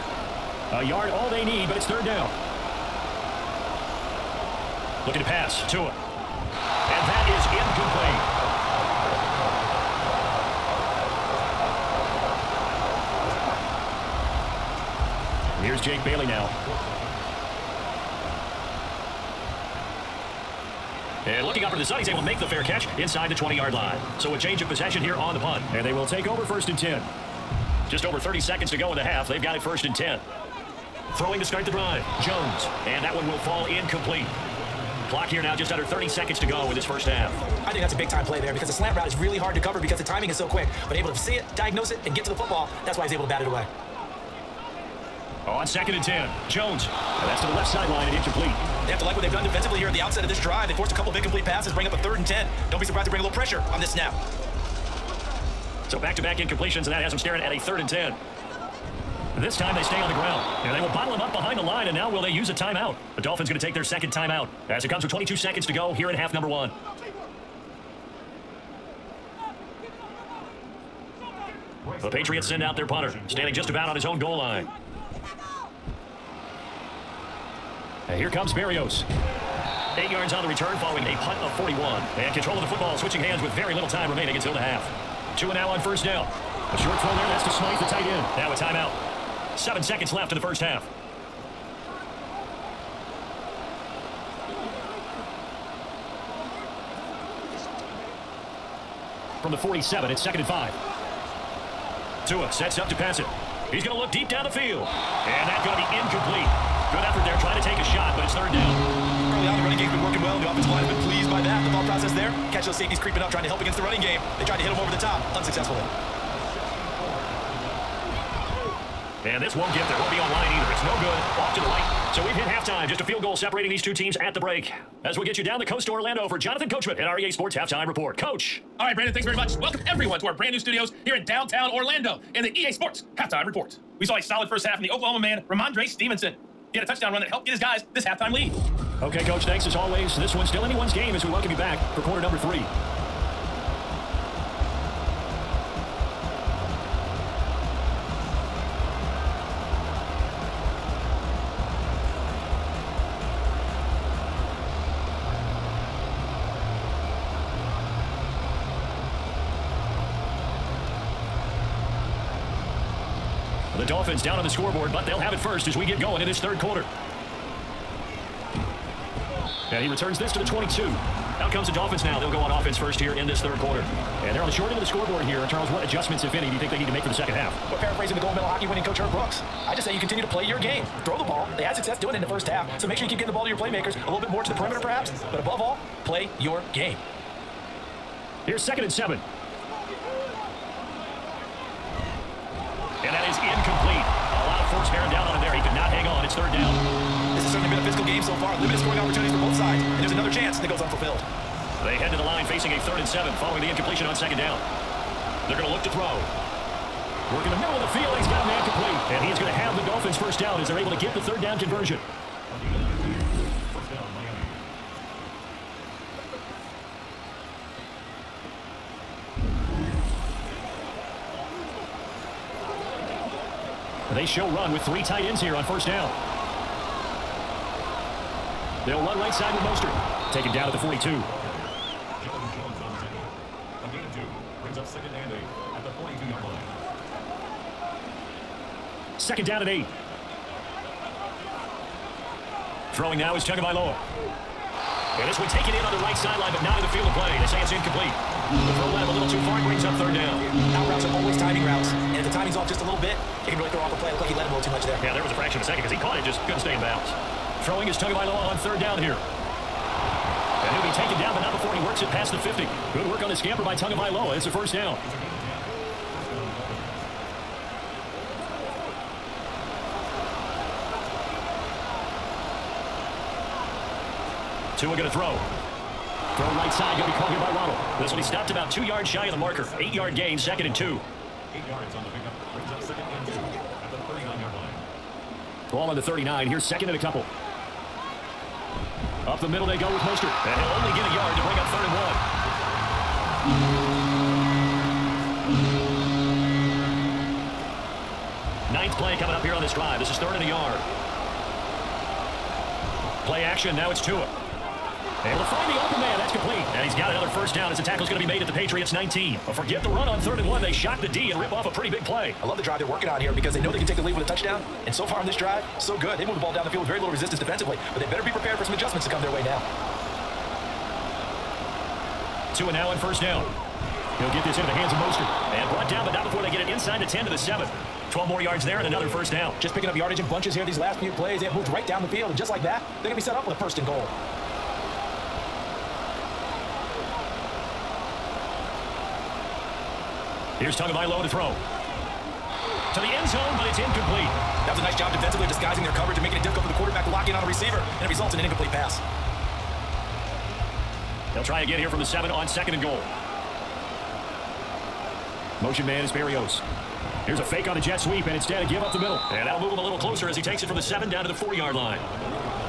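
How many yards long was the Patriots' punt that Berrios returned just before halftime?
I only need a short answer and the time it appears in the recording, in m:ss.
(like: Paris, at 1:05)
41, at 1:21.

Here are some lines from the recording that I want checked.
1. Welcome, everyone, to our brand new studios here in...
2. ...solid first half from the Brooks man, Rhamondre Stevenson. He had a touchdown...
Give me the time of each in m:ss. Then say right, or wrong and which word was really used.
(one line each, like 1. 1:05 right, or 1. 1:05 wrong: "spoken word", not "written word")
1. 2:09 right
2. 2:14 wrong: "Oklahoma", not "Brooks".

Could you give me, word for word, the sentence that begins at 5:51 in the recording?
They'll try again here from the seven on second and goal.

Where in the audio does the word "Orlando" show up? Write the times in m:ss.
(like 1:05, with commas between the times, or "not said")
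2:05, 2:11.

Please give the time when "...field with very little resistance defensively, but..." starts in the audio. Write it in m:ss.
5:16.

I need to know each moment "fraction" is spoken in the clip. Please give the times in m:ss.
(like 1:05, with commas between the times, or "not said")
4:15.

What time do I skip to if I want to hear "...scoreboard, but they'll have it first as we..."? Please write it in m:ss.
2:44.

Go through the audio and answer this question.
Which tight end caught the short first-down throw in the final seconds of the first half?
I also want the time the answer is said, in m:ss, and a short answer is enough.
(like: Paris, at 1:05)
Smythe, at 1:27.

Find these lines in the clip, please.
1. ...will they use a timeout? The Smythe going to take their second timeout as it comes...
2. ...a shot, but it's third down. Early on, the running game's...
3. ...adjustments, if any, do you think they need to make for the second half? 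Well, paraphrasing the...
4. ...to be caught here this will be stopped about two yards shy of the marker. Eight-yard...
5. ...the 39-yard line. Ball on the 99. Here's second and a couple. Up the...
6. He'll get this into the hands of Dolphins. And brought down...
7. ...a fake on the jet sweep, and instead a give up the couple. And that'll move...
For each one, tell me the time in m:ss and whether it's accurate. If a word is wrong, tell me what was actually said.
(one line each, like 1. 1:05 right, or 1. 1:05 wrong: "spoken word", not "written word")
1. 1:02 wrong: "Dolphins", not "Smythe"
2. 1:47 right
3. 2:55 right
4. 4:37 right
5. 4:43 wrong: "39", not "99"
6. 5:24 wrong: "Mostert", not "Dolphins"
7. 5:57 wrong: "middle", not "couple".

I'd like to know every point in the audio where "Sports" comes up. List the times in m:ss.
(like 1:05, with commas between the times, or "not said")
2:07, 2:12.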